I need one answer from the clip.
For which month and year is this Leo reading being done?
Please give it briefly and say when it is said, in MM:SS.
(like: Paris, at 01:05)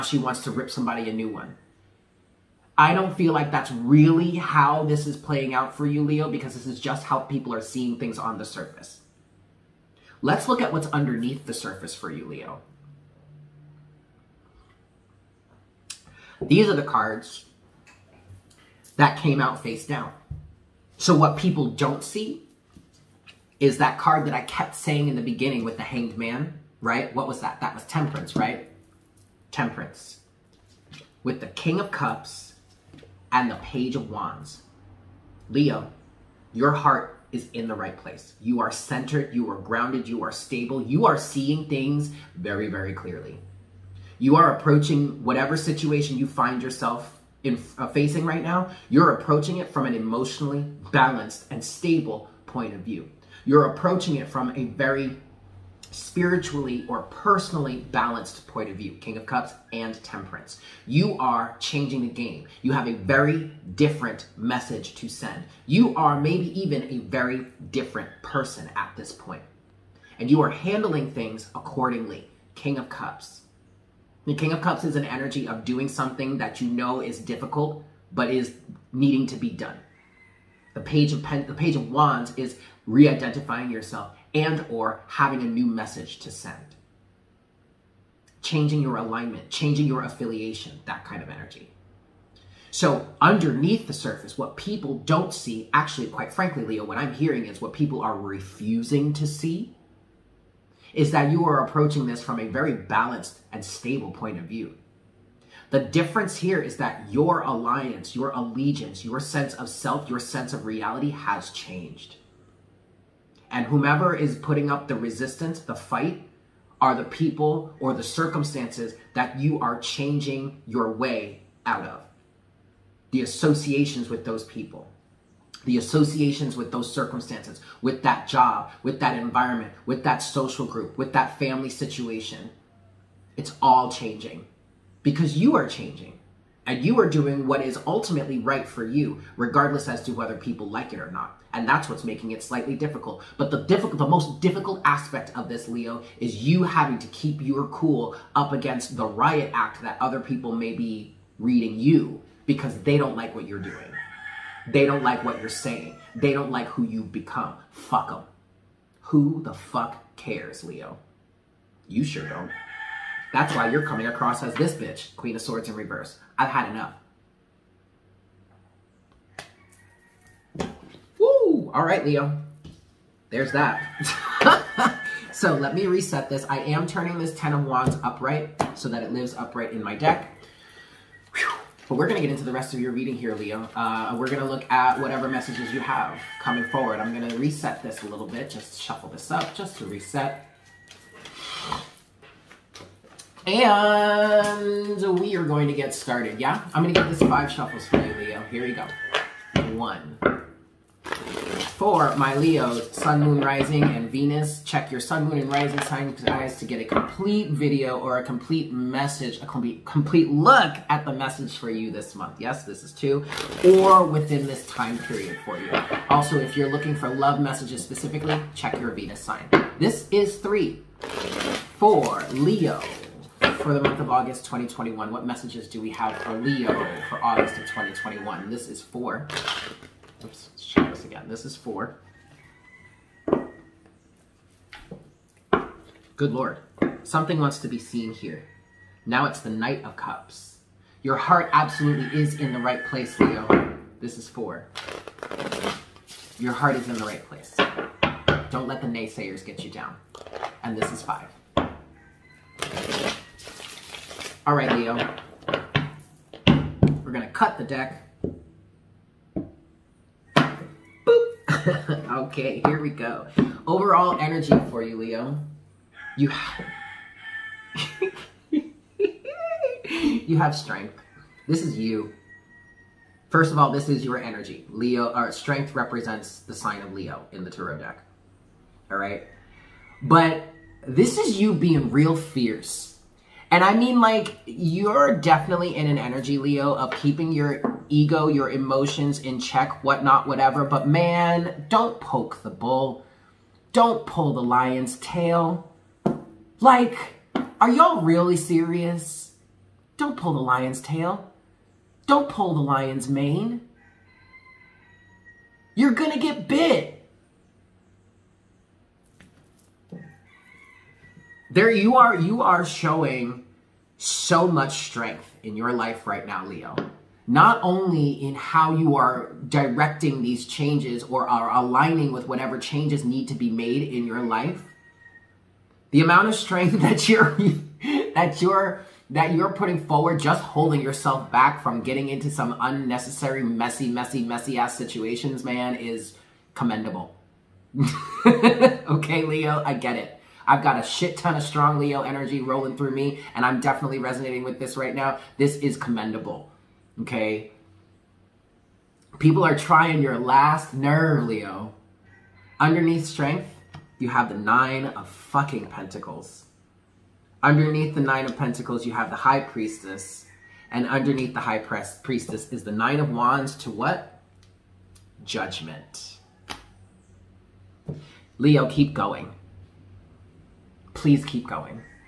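August 2021, at 03:44.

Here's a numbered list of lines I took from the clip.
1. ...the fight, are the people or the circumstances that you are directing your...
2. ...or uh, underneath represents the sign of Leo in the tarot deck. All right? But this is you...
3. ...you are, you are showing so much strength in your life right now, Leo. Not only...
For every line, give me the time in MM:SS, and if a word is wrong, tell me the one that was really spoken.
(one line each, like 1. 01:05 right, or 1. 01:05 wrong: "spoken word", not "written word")
1. 01:55 wrong: "changing", not "directing"
2. 04:35 wrong: "strength", not "underneath"
3. 05:11 right.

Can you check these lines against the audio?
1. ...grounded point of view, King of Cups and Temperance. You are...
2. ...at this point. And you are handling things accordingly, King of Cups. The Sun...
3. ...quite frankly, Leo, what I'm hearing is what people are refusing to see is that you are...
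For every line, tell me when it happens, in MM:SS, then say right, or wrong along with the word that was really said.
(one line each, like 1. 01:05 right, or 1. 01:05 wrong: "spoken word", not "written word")
1. 00:57 wrong: "balanced", not "grounded"
2. 01:08 wrong: "King", not "Sun"
3. 01:36 right.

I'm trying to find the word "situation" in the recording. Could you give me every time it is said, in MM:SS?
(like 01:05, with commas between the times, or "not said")
00:45, 02:11, 05:34.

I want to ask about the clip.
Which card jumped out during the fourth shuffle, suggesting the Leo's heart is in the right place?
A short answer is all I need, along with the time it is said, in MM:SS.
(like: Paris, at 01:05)
Knight of Cups, at 03:59.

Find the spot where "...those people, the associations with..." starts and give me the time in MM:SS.
02:04.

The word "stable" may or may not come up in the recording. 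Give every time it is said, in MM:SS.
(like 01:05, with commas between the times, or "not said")
00:40, 00:51, 01:43.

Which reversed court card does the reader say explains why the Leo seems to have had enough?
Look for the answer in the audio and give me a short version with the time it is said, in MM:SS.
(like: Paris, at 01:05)
Queen of Swords, at 02:45.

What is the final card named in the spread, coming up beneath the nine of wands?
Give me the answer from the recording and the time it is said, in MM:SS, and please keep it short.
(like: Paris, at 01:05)
Judgment, at 06:05.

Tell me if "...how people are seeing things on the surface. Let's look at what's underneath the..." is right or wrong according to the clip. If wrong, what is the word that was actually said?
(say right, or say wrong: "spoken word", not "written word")
right.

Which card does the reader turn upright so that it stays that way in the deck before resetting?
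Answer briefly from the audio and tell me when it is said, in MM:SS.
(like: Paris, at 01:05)
10 of wands, at 02:57.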